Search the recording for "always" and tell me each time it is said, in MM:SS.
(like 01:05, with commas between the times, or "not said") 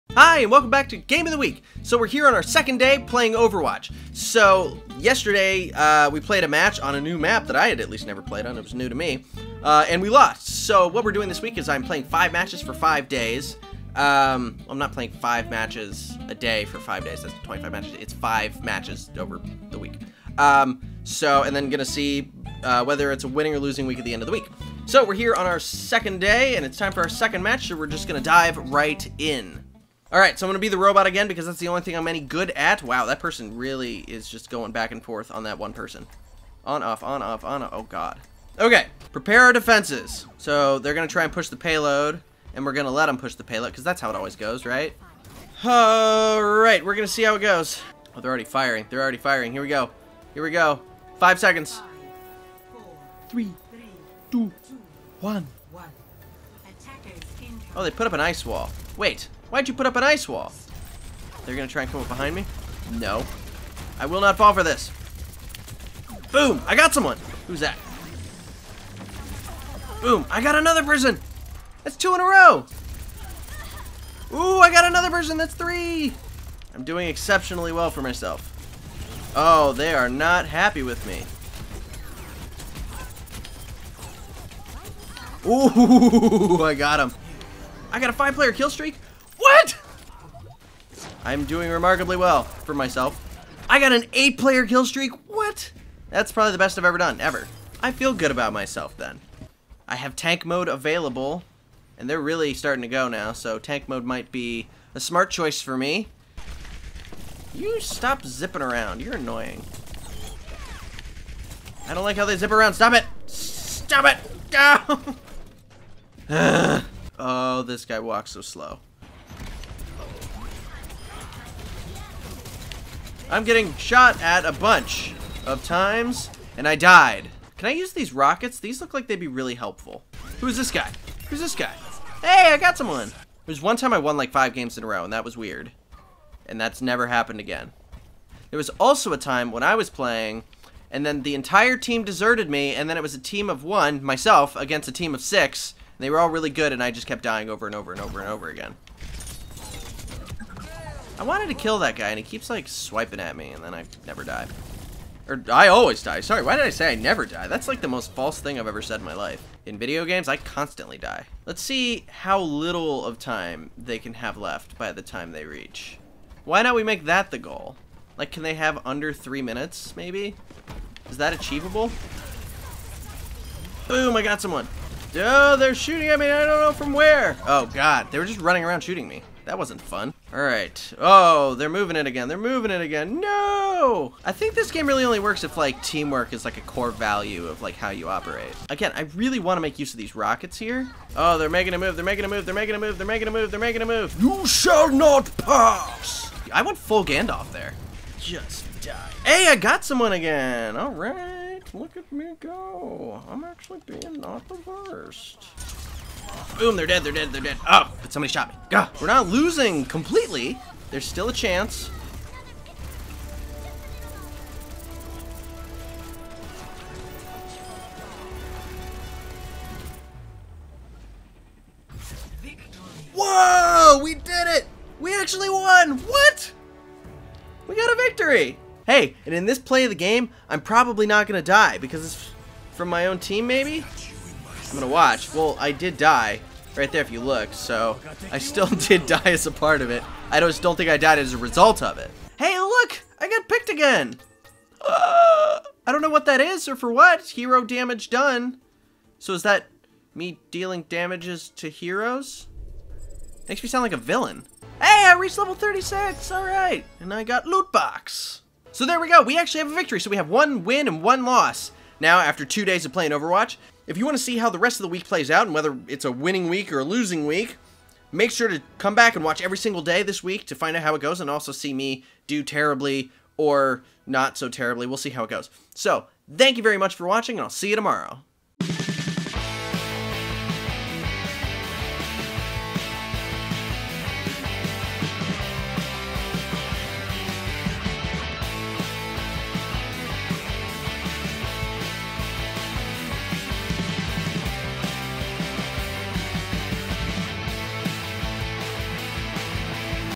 00:44, 02:35.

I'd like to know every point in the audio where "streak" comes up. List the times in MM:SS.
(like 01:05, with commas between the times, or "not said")
01:28, 01:34.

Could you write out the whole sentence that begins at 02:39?
In video games, I constantly die.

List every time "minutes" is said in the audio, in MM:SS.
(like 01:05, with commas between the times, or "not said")
02:49.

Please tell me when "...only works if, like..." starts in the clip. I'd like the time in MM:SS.
03:05.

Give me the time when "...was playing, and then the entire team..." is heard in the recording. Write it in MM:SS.
02:19.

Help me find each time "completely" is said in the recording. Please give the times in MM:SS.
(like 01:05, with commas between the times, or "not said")
03:29.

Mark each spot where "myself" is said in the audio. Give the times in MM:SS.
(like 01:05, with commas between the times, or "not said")
01:18, 01:32, 01:38, 02:24.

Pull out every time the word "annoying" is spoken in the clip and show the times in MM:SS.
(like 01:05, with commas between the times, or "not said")
01:49.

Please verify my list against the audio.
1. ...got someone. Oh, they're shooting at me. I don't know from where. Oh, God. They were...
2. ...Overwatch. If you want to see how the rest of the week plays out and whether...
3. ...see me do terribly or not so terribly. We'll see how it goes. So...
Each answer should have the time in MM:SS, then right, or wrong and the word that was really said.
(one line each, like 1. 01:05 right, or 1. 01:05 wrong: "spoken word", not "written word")
1. 02:54 right
2. 04:23 right
3. 04:31 right.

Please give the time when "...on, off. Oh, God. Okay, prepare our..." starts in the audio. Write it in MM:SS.
00:37.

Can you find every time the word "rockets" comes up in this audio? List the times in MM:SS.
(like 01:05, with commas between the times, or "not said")
02:08, 03:10.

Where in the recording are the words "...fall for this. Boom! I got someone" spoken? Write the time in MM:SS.
01:04.